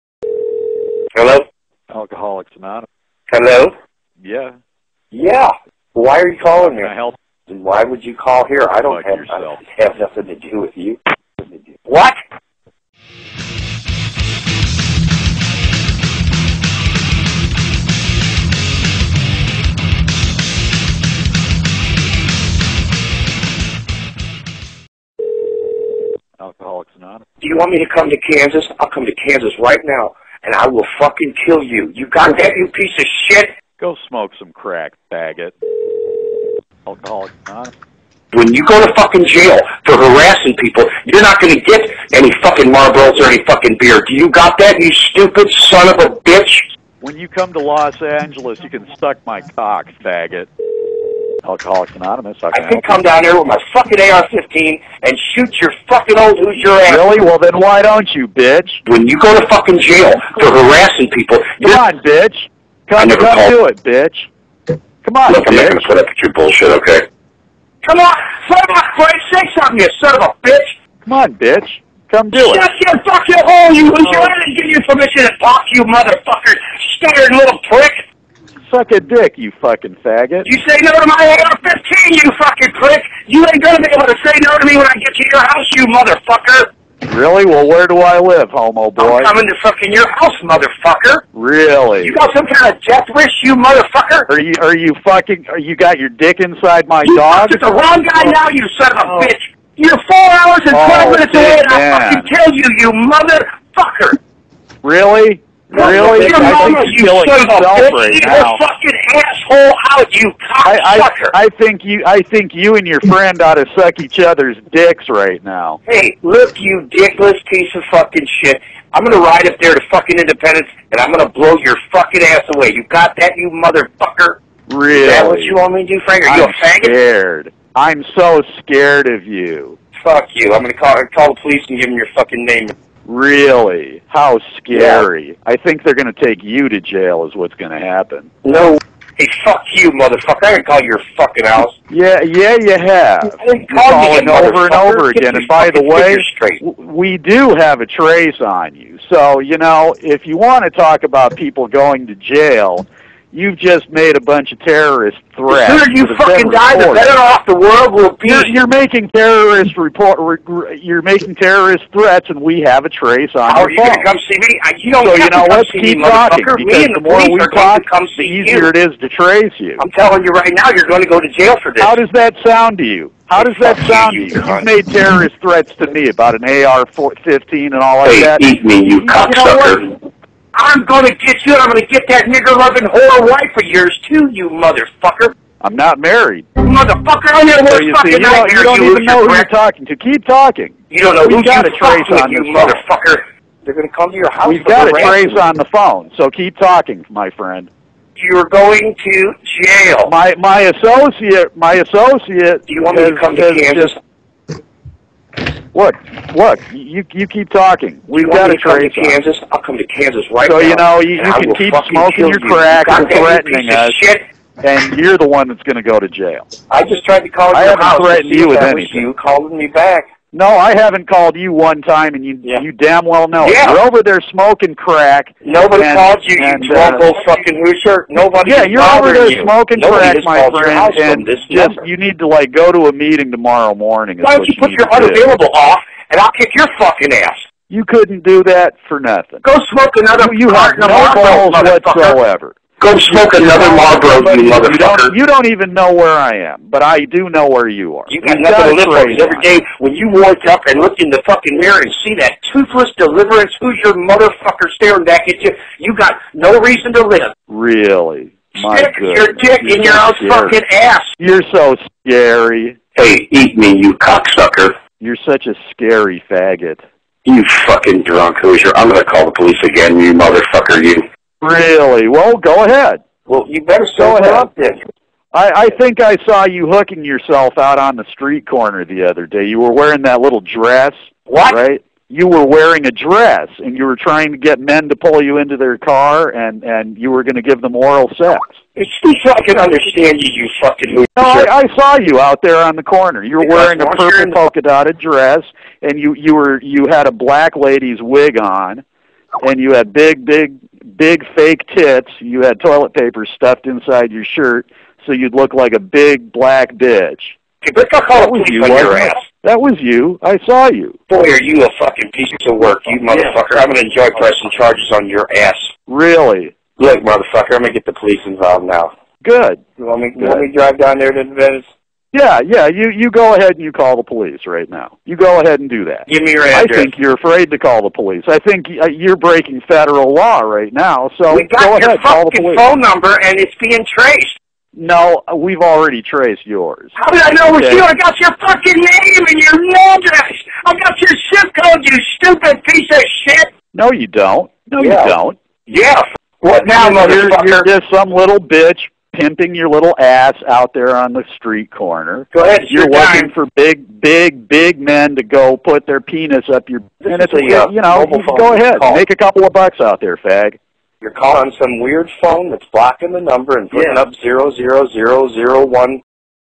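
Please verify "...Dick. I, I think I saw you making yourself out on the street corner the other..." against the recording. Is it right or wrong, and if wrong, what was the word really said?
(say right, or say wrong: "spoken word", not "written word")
wrong: "hooking", not "making".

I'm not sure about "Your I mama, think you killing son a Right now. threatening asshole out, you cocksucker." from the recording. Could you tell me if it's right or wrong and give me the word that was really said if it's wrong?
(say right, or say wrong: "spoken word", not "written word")
wrong: "fucking", not "threatening".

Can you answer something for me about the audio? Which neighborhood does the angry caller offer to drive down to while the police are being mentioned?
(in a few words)
Venice.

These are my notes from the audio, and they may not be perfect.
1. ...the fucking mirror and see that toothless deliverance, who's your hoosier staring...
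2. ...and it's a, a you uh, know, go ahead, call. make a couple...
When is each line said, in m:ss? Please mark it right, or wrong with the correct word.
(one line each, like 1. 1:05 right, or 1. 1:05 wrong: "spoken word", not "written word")
1. 4:11 wrong: "motherfucker", not "hoosier"
2. 5:57 right.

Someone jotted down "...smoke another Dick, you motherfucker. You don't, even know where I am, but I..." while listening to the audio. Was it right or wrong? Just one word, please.
wrong.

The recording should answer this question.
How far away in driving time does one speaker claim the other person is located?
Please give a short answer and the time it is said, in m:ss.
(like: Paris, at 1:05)
4 hours 12 minutes, at 1:40.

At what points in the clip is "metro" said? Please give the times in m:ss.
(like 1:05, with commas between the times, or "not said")
not said.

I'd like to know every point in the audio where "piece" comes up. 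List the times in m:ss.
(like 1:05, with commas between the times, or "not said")
0:32, 1:57, 5:12, 5:42.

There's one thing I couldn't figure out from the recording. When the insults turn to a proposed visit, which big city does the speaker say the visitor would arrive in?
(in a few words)
Los Angeles.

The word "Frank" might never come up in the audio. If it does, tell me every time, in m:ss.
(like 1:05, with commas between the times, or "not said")
1:08, 2:06.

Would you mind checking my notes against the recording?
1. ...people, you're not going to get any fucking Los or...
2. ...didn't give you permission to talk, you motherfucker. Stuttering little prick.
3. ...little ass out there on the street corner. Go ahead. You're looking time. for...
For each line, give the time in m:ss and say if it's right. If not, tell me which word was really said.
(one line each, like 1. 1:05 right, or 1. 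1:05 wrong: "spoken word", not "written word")
1. 0:40 wrong: "Marlboros", not "Los"
2. 1:14 right
3. 5:49 right.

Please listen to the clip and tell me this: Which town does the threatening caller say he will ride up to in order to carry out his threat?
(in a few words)
Independence.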